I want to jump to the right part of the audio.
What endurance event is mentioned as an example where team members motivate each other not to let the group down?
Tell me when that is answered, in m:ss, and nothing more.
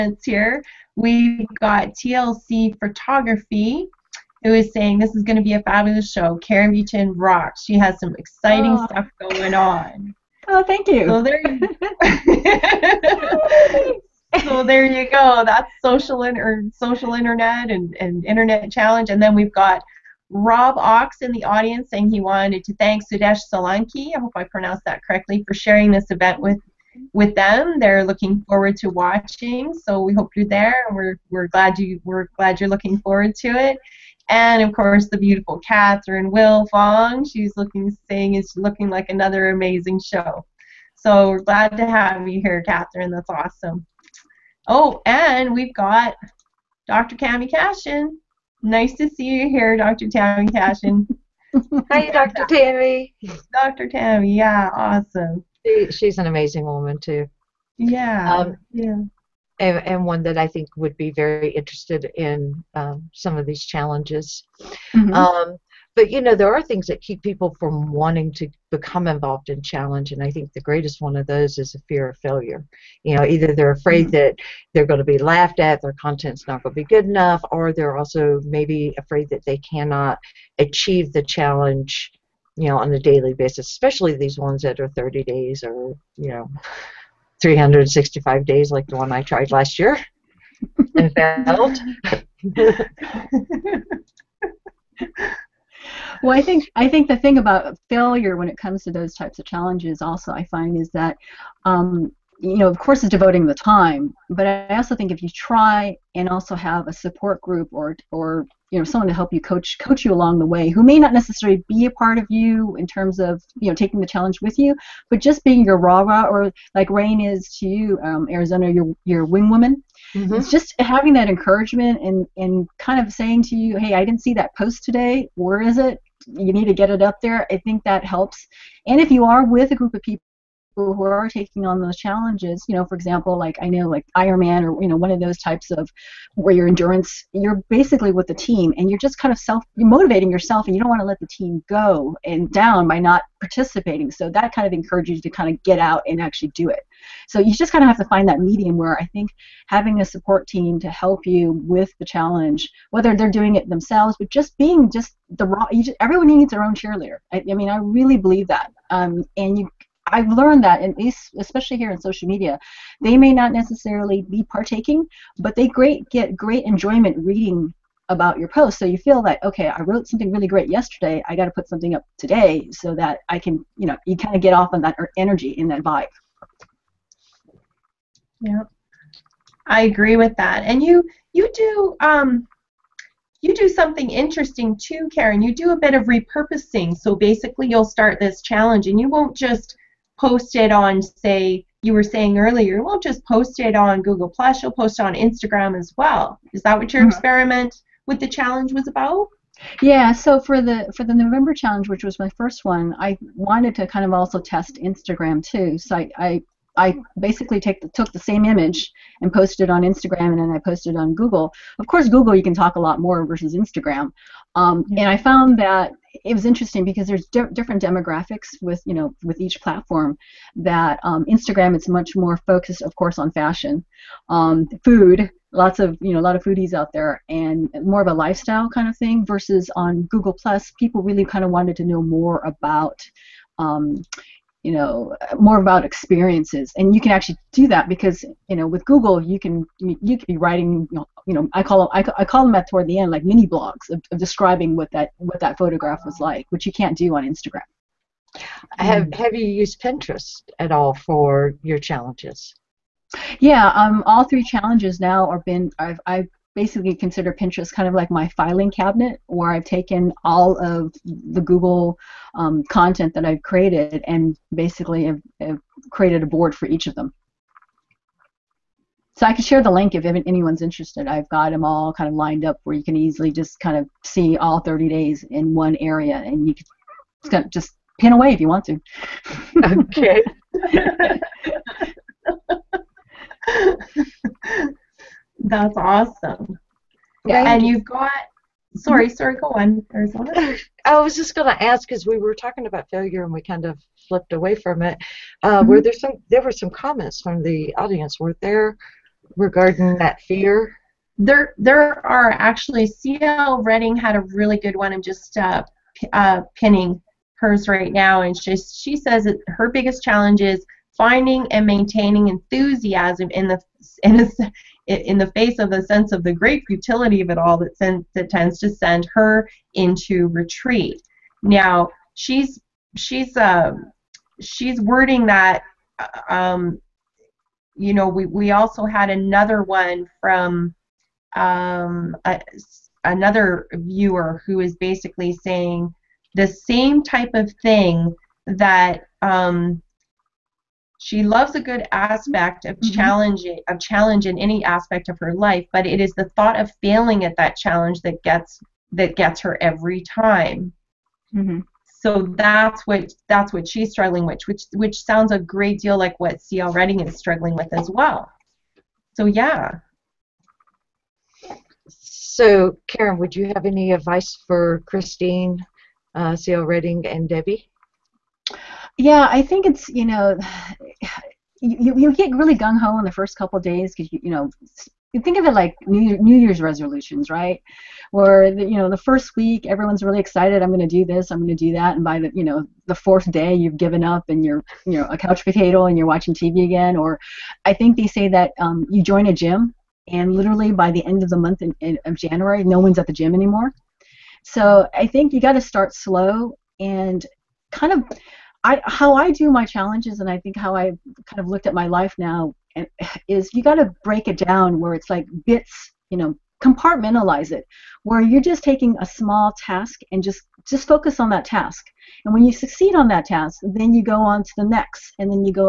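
2:14.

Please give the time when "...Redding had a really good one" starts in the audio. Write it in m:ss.
5:03.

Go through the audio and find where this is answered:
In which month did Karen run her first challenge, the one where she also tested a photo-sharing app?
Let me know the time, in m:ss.
3:21.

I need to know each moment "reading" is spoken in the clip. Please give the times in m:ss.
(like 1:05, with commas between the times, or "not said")
2:47, 5:56, 6:06.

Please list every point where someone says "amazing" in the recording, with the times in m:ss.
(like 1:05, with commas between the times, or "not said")
0:39, 0:56.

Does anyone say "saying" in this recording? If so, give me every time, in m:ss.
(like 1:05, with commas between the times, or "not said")
0:04, 0:21, 0:38, 2:03, 3:12, 5:35.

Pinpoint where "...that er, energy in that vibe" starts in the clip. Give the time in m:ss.
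2:54.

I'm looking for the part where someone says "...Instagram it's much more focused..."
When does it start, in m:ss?
3:41.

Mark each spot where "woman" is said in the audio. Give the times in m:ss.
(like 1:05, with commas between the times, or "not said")
0:56, 1:59.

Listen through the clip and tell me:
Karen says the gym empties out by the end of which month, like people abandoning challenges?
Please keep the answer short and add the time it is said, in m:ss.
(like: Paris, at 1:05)
January, at 6:32.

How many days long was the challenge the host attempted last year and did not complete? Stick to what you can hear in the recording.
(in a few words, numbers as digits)
365.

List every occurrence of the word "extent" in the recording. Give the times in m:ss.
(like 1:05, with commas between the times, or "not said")
not said.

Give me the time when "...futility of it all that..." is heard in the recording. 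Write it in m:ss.
5:16.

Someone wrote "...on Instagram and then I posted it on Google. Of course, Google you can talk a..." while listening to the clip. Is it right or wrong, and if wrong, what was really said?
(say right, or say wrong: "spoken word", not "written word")
right.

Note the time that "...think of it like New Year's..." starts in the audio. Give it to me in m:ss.
6:15.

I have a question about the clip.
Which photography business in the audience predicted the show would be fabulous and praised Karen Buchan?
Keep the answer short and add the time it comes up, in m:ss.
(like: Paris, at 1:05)
TLC Photography, at 0:01.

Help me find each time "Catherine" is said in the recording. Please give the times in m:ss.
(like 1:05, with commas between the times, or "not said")
0:35, 0:42.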